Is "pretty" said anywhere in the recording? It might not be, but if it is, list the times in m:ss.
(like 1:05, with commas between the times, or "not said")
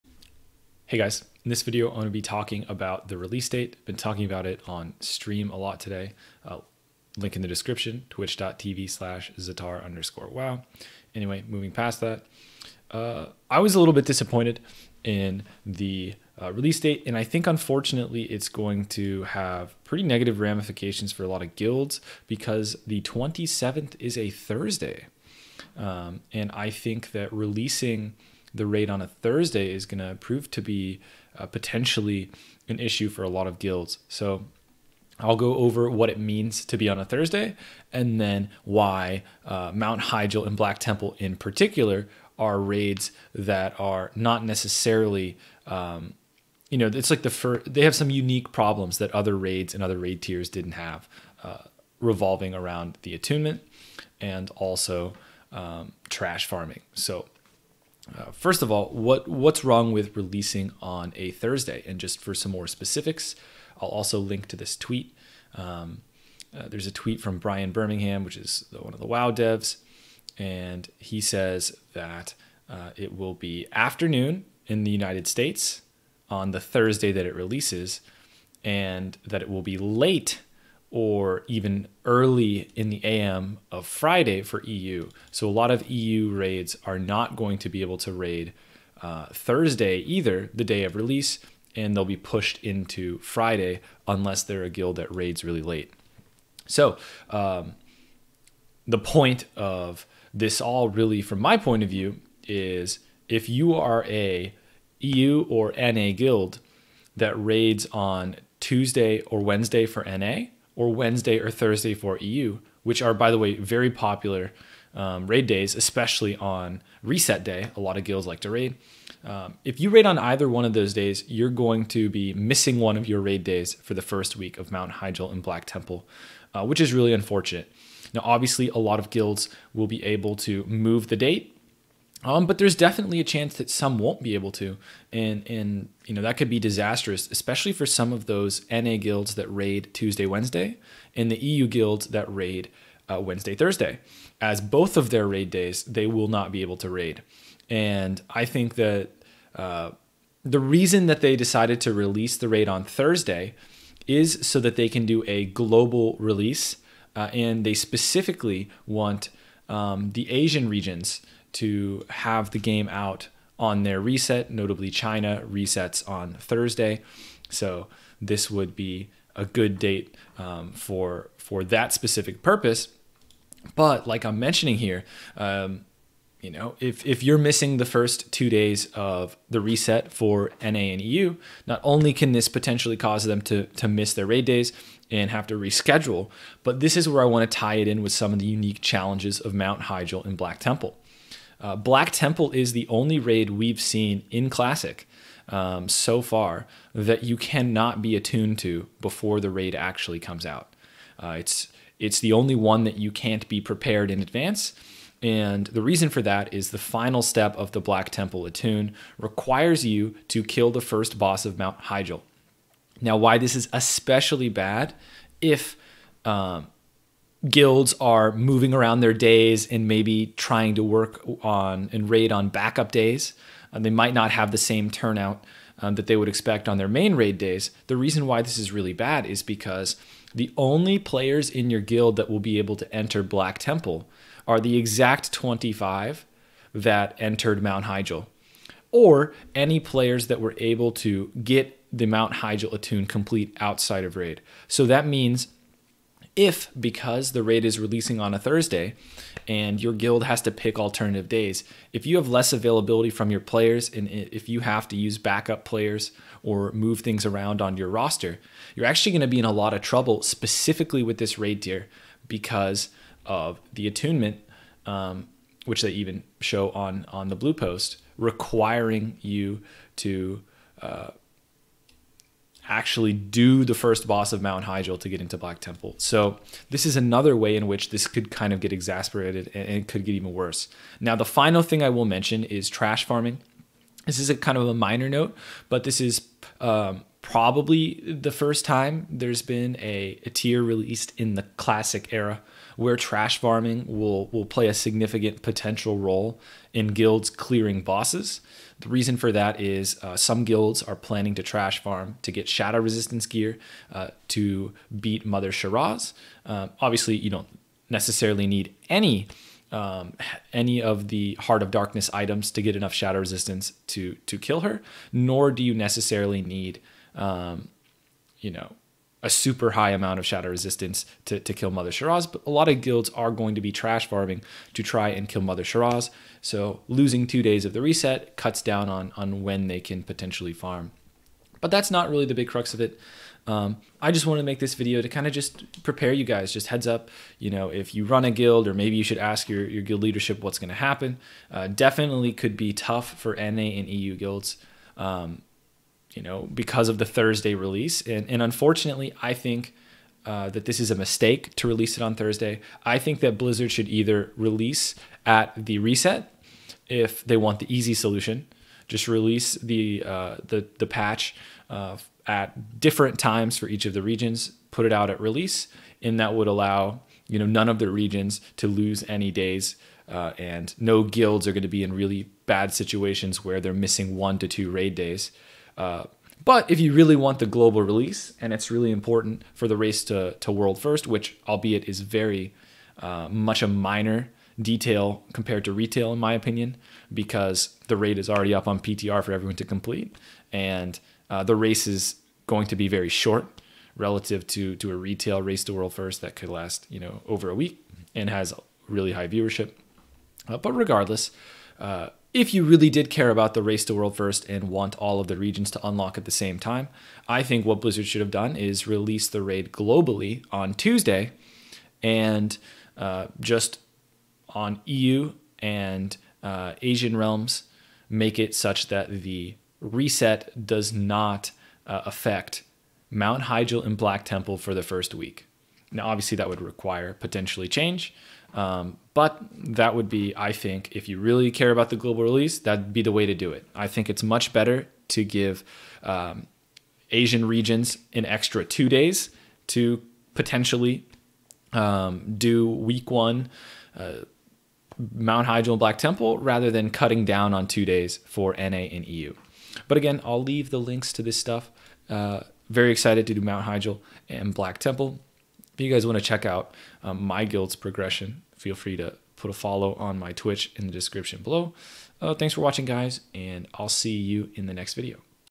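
0:19.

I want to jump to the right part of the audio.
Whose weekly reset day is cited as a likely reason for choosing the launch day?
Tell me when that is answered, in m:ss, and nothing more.
2:44.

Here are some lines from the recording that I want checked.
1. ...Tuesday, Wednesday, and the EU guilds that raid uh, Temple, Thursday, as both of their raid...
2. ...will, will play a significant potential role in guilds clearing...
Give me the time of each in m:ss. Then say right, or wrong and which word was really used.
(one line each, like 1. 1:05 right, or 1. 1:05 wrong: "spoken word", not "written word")
1. 2:19 wrong: "Wednesday", not "Temple"
2. 4:53 right.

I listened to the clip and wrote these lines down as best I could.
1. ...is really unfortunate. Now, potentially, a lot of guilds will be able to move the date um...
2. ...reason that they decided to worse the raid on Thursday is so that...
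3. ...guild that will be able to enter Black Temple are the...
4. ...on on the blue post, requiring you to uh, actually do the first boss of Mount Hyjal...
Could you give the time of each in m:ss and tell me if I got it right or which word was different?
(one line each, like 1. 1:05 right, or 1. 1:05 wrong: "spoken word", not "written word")
1. 2:06 wrong: "obviously", not "potentially"
2. 2:30 wrong: "release", not "worse"
3. 3:51 right
4. 4:26 right.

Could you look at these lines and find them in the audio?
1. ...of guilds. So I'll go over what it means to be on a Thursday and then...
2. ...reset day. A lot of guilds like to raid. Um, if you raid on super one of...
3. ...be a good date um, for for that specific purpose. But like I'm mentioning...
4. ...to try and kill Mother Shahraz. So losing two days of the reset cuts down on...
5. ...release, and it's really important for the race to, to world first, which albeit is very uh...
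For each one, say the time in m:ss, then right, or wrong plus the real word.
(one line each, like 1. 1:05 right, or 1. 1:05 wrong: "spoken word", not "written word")
1. 0:33 right
2. 1:57 wrong: "either", not "super"
3. 2:48 right
4. 5:24 right
5. 6:17 right.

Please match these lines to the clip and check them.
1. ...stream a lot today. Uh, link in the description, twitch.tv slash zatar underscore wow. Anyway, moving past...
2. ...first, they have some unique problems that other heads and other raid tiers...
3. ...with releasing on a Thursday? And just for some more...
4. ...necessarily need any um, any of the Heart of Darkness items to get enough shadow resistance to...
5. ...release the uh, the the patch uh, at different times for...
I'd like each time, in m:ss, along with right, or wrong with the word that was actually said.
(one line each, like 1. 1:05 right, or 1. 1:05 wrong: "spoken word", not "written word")
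1. 0:04 right
2. 0:47 wrong: "raids", not "heads"
3. 0:59 right
4. 5:07 right
5. 5:59 right.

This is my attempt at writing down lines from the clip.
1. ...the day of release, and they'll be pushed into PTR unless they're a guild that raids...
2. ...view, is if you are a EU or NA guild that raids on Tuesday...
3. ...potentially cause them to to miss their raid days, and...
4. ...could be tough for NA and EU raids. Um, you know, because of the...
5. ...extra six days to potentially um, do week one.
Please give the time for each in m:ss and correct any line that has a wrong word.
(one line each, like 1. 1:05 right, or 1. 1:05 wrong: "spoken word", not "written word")
1. 1:30 wrong: "Friday", not "PTR"
2. 1:41 right
3. 3:02 right
4. 5:42 wrong: "guilds", not "raids"
5. 7:18 wrong: "two", not "six".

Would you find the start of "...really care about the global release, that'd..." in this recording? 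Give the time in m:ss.
7:11.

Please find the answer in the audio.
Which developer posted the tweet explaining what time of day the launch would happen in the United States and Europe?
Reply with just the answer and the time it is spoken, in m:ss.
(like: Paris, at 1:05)
Brian Birmingham, at 1:07.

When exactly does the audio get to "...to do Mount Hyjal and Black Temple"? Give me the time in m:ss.
7:33.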